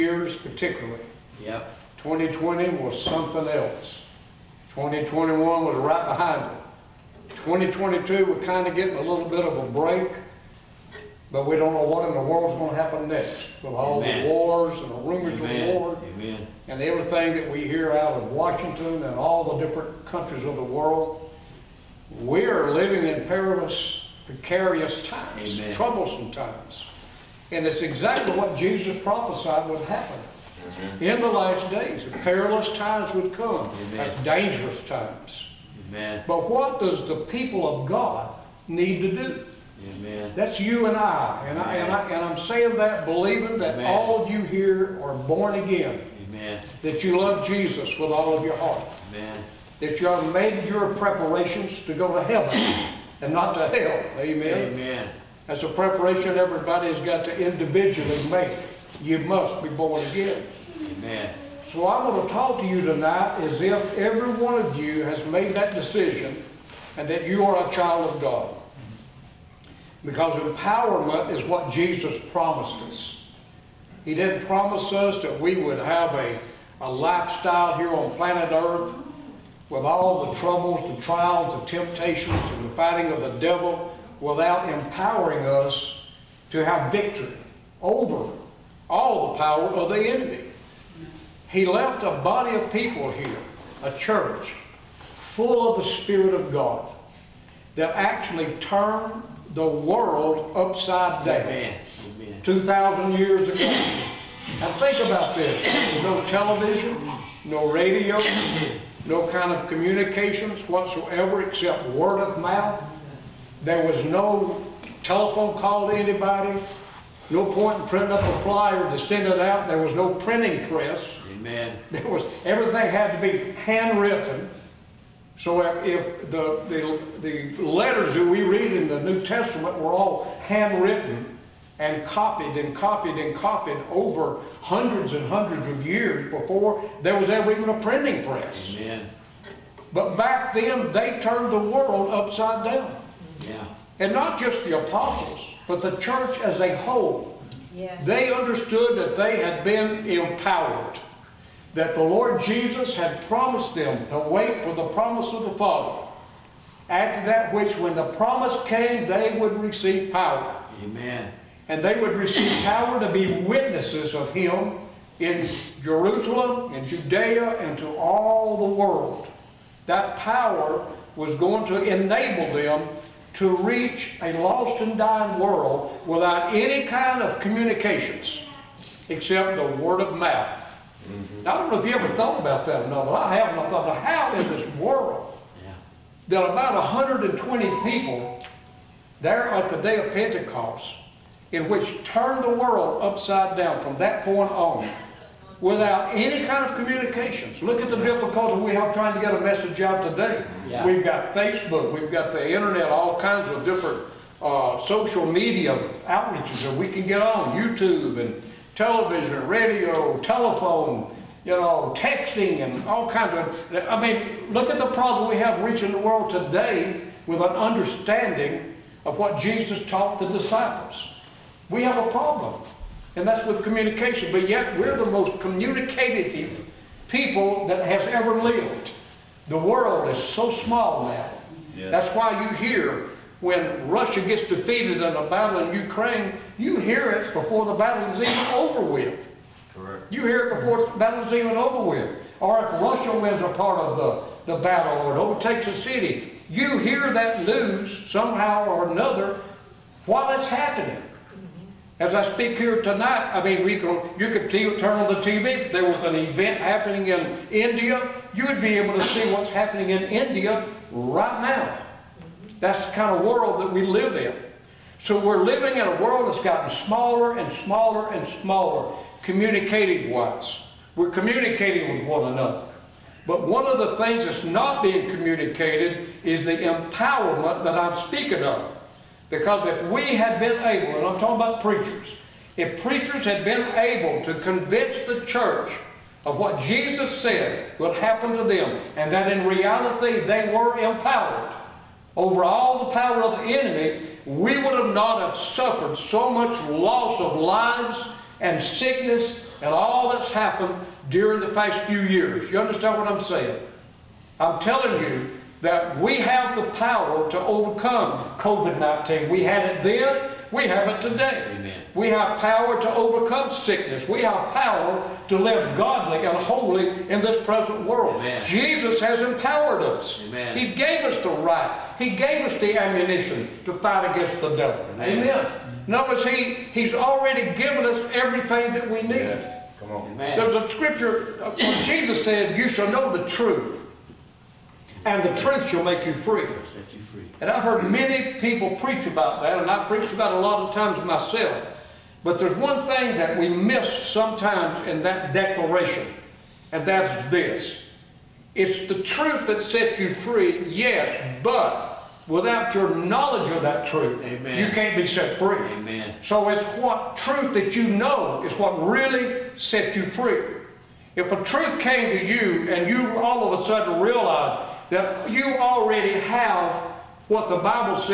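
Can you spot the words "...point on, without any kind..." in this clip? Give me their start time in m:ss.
3:14.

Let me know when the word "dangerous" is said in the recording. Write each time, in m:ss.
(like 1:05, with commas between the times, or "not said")
0:34.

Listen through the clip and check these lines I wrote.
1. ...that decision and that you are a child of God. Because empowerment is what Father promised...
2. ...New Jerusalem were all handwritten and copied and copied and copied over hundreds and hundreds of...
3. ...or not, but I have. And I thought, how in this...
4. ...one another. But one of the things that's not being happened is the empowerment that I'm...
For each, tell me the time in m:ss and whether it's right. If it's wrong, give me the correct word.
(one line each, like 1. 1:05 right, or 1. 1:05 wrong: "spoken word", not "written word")
1. 1:05 wrong: "Jesus", not "Father"
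2. 2:09 wrong: "Testament", not "Jerusalem"
3. 3:02 right
4. 4:32 wrong: "communicated", not "happened".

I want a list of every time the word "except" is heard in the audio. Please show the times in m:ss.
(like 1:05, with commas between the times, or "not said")
1:51, 2:59.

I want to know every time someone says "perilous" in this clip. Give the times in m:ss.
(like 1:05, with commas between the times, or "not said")
0:23, 0:32.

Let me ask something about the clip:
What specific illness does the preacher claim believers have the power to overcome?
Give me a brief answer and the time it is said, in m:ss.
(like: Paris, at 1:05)
COVID-19, at 5:08.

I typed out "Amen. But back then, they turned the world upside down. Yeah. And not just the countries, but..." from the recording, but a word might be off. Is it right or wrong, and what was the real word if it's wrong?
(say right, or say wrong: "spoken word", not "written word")
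wrong: "apostles", not "countries".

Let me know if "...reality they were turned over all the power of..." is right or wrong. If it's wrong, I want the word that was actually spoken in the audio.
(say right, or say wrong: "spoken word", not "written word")
wrong: "empowered", not "turned".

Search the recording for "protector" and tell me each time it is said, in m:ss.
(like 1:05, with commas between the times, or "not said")
not said.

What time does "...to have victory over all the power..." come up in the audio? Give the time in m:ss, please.
1:26.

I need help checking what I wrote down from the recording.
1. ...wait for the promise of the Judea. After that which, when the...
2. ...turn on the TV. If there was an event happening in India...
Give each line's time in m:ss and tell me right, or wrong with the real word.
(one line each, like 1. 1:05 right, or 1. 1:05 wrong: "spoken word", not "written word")
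1. 2:34 wrong: "Father", not "Judea"
2. 4:14 right.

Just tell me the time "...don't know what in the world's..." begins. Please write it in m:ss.
0:11.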